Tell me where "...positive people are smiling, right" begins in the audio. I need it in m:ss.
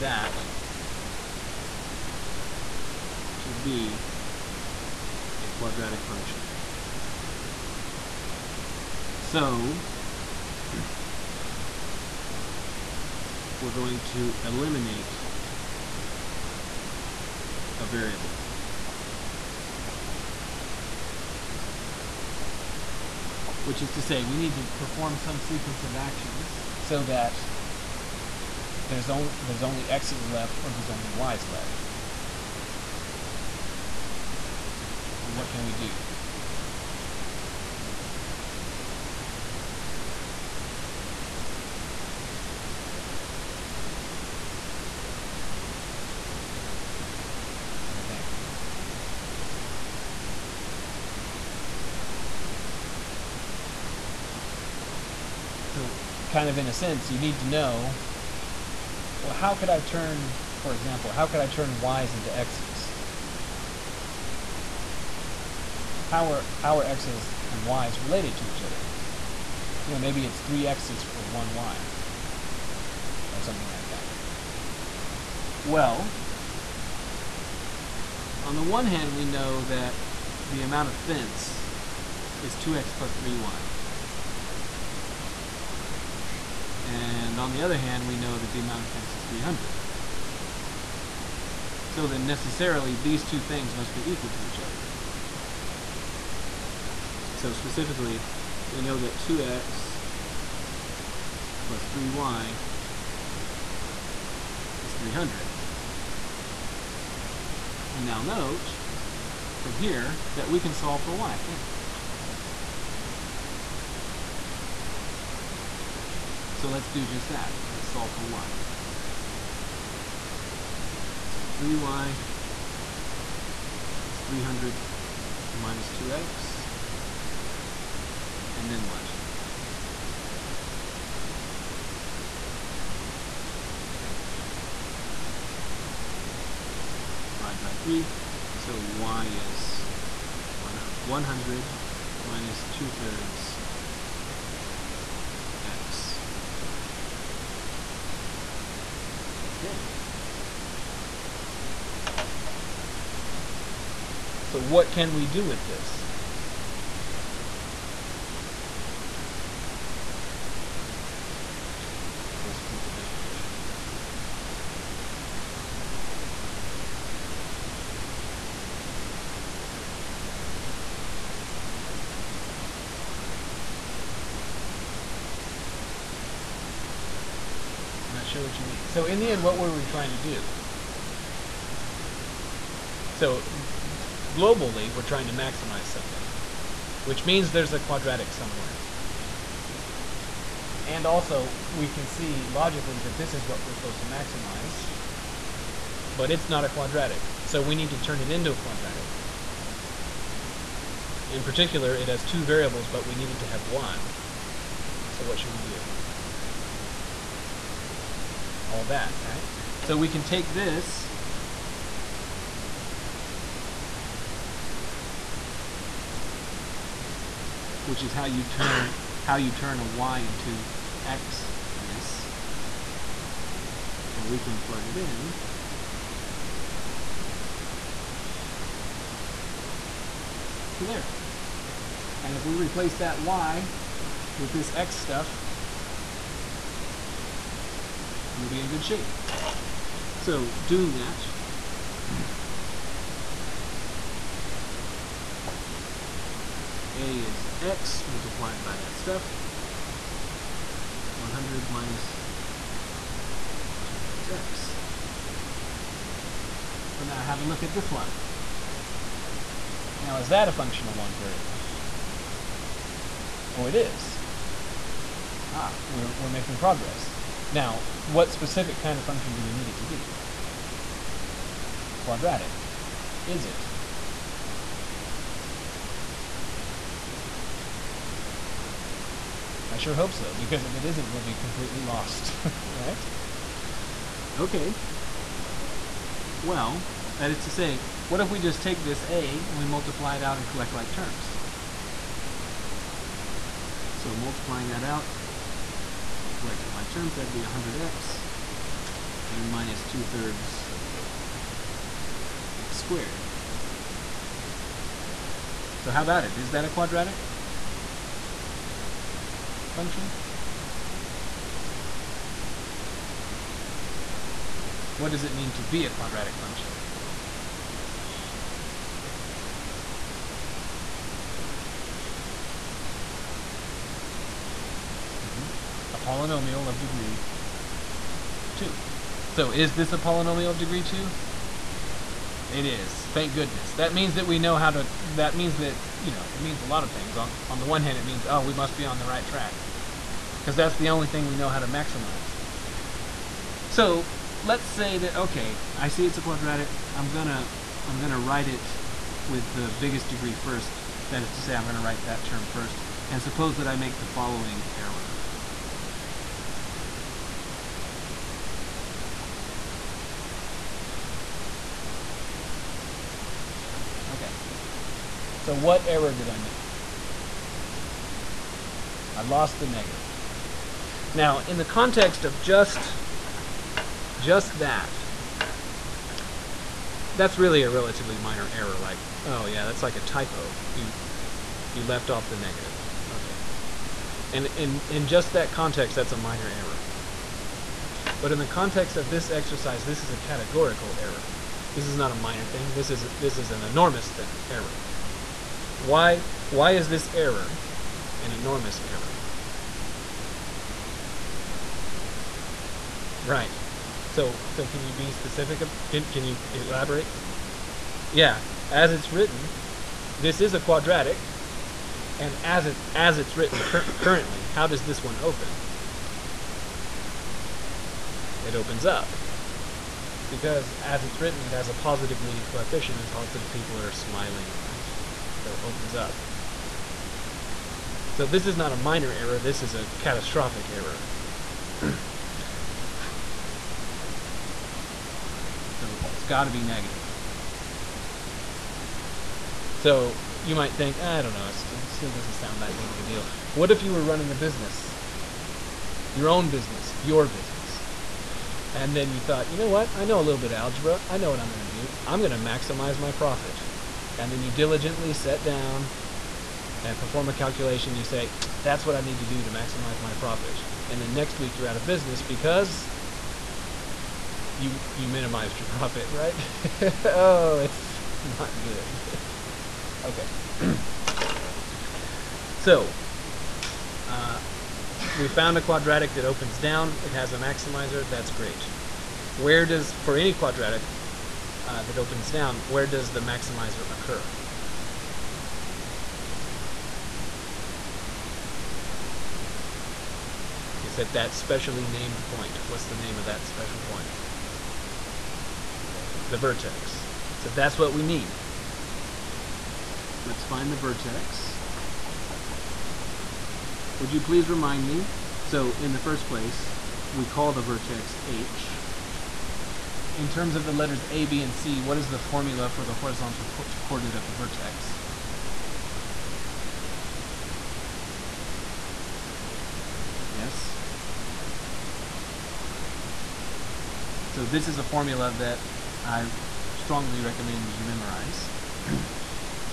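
7:03.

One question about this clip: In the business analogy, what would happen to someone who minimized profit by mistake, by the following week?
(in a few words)
Out of business.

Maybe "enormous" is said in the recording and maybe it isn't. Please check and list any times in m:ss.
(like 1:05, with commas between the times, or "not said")
6:33, 6:38.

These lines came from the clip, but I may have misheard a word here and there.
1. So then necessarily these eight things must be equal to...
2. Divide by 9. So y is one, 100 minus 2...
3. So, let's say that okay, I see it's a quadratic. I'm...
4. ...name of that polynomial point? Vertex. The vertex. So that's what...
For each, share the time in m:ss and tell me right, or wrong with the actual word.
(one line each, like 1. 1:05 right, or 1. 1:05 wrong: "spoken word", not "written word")
1. 1:31 wrong: "two", not "eight"
2. 2:17 wrong: "3", not "9"
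3. 5:43 right
4. 8:12 wrong: "special", not "polynomial".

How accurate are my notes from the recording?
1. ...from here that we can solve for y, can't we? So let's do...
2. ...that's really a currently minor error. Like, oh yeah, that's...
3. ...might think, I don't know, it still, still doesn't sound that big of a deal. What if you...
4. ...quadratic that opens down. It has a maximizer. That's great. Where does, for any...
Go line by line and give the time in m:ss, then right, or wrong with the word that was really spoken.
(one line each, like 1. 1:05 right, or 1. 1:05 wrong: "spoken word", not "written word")
1. 1:49 right
2. 6:17 wrong: "relatively", not "currently"
3. 7:20 right
4. 7:55 right.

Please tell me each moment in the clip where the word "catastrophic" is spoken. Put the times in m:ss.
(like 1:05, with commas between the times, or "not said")
7:09.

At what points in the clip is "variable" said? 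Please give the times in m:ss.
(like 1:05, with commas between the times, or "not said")
0:17, 3:22, 4:21.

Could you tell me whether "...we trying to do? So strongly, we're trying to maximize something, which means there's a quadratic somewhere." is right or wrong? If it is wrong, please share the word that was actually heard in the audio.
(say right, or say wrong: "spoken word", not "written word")
wrong: "globally", not "strongly".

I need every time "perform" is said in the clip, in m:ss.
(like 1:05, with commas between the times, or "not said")
0:24, 7:36.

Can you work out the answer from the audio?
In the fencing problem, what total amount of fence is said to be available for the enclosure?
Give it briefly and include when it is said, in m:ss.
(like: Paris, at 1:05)
300, at 1:28.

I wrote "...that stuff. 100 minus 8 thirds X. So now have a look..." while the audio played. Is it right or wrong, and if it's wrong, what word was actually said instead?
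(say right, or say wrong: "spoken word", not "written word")
wrong: "2", not "8".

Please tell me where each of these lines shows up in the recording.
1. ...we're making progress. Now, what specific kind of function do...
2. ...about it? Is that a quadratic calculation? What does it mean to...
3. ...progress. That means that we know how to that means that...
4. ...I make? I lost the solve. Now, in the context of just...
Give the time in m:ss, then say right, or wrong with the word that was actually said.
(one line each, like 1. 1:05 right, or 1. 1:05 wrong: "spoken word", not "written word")
1. 4:26 right
2. 5:06 wrong: "function", not "calculation"
3. 5:33 wrong: "goodness", not "progress"
4. 6:06 wrong: "negative", not "solve".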